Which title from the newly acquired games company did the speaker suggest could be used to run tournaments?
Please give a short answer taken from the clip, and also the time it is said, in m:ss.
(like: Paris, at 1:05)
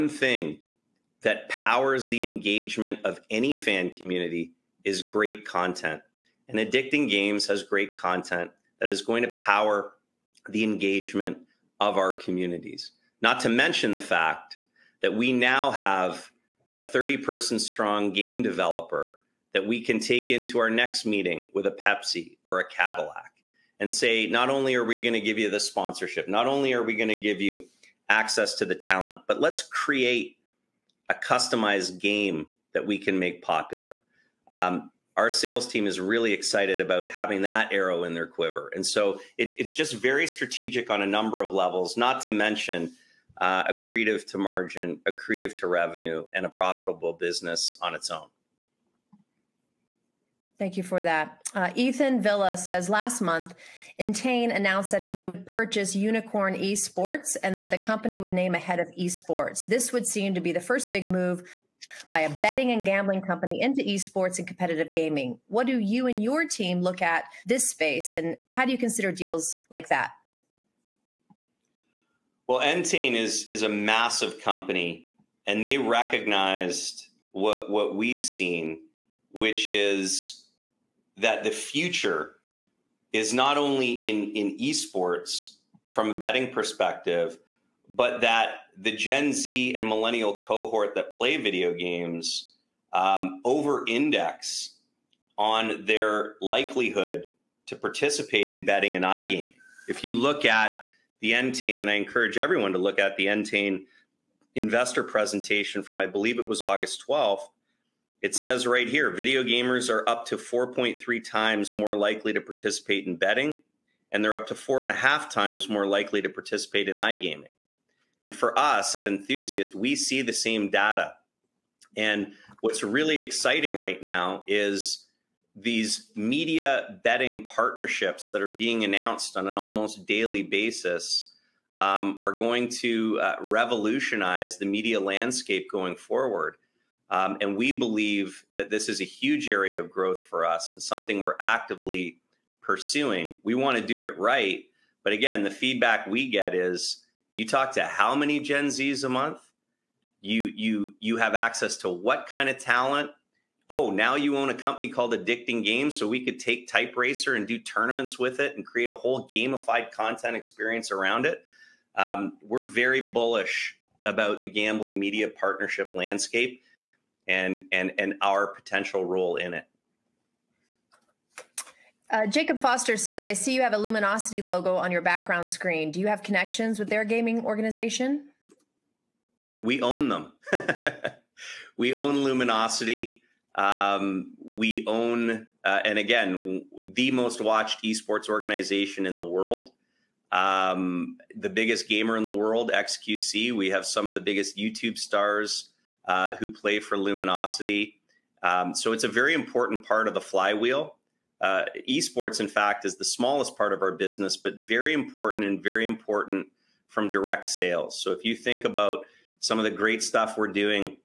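Type Racer, at 2:36.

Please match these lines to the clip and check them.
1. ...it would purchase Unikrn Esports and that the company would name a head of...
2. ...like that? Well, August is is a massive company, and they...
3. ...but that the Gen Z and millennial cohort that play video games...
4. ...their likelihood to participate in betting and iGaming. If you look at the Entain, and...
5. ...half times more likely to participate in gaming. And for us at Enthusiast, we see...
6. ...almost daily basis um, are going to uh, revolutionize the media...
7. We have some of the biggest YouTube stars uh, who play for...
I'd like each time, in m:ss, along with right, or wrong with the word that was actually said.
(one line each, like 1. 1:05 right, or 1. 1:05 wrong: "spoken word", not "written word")
1. 0:55 right
2. 1:09 wrong: "Entain", not "August"
3. 1:27 right
4. 1:35 right
5. 1:54 wrong: "iGaming", not "gaming"
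6. 2:09 right
7. 3:13 right.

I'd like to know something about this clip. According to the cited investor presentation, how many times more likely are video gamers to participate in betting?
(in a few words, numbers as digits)
4.3 times.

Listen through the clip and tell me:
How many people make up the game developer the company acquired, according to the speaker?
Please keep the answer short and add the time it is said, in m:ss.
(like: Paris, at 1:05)
30, at 0:16.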